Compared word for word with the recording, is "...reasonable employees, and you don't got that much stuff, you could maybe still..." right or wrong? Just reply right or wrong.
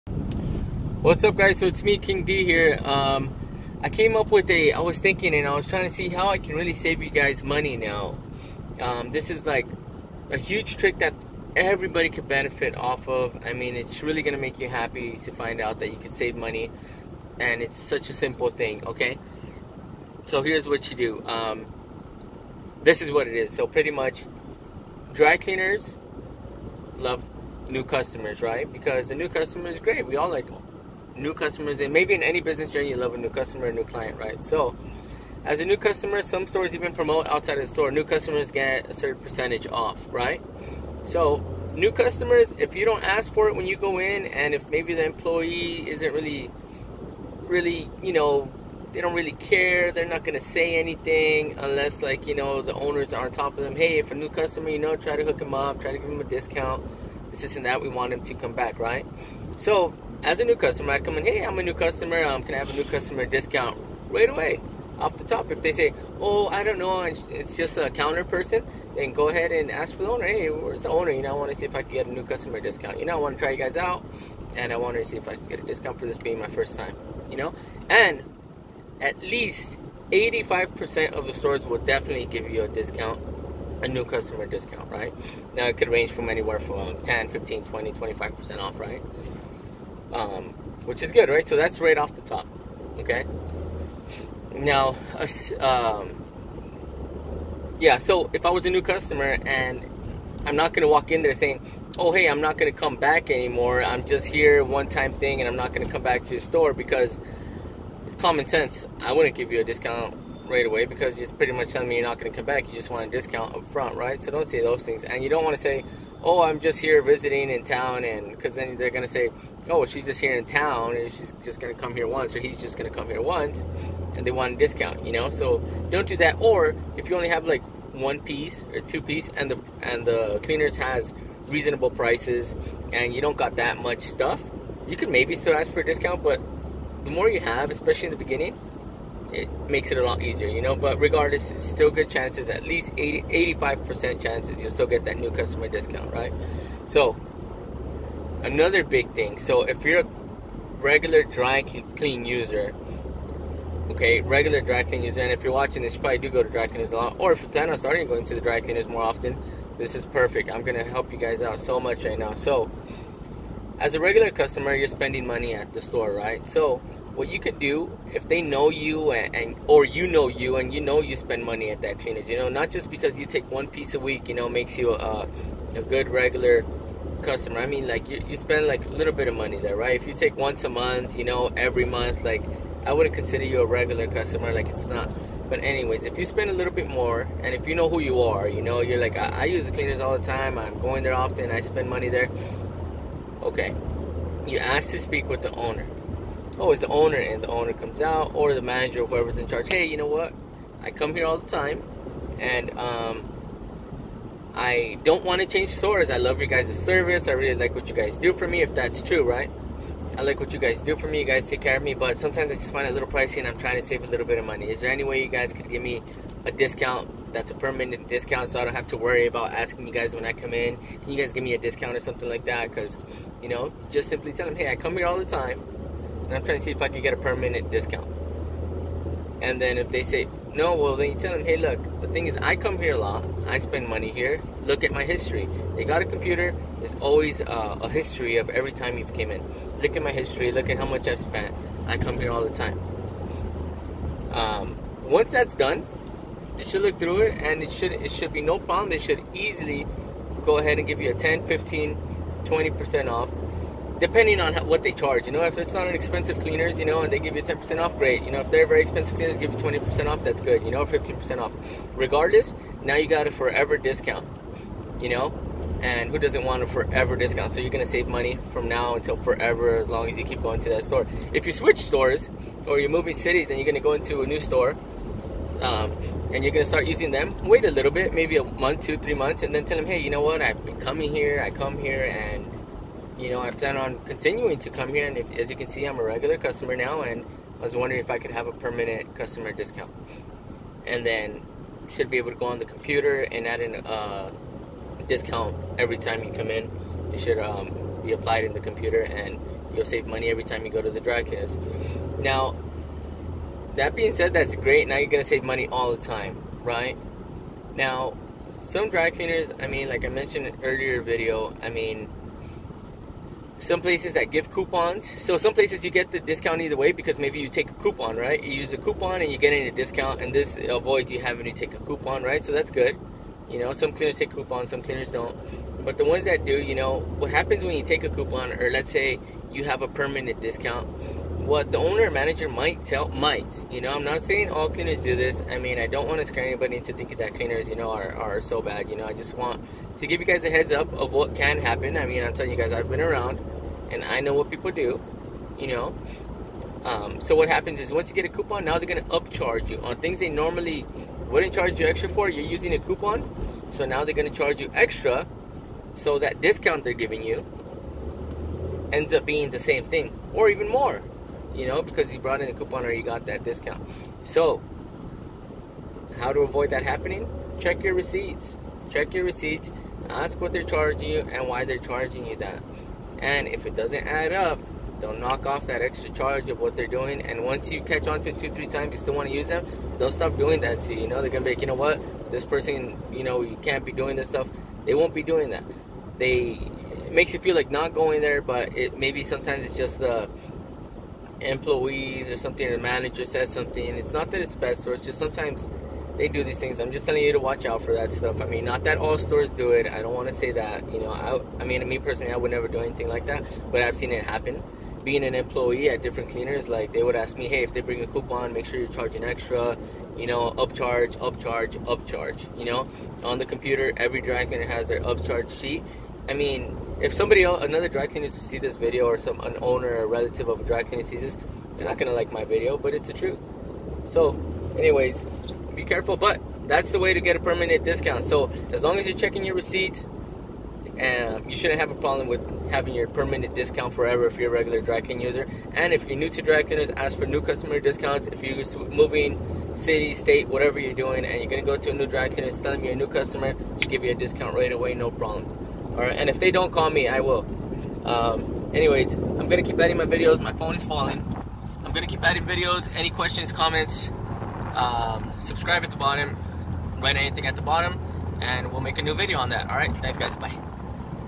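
wrong.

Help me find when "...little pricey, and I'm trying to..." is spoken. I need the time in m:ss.
3:32.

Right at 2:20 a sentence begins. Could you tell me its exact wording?
But regardless, it's still good chances, at least 80, 85% chances you'll still get that new customer discount, right?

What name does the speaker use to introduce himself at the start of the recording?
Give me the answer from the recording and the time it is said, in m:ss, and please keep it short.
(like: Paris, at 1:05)
King D, at 0:01.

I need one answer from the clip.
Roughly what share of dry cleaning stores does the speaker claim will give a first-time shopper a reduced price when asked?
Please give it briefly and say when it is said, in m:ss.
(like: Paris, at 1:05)
85%, at 1:18.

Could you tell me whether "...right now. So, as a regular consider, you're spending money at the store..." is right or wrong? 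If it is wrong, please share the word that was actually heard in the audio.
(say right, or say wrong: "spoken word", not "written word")
wrong: "customer", not "consider".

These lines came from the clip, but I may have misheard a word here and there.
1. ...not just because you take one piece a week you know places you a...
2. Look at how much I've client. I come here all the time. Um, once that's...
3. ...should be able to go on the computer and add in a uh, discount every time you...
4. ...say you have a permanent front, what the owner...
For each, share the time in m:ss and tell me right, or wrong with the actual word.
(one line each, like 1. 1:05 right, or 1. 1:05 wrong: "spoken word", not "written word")
1. 2:52 wrong: "makes", not "places"
2. 4:00 wrong: "spent", not "client"
3. 4:51 right
4. 5:28 wrong: "discount", not "front".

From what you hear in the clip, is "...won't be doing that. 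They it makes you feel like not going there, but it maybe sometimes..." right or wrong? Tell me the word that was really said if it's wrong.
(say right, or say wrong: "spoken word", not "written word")
right.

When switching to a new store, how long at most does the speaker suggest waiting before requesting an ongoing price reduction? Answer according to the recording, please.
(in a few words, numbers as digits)
3 months.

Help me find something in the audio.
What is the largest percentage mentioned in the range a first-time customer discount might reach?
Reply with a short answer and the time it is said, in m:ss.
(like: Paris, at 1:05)
25%, at 1:27.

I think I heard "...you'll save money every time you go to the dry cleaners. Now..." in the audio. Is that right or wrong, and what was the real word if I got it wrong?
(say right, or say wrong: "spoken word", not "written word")
right.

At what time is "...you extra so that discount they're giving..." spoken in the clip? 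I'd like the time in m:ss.
5:54.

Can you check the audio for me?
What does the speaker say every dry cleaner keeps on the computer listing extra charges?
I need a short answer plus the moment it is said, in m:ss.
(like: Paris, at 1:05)
upcharge sheet, at 6:55.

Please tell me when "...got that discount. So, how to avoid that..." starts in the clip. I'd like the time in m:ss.
6:03.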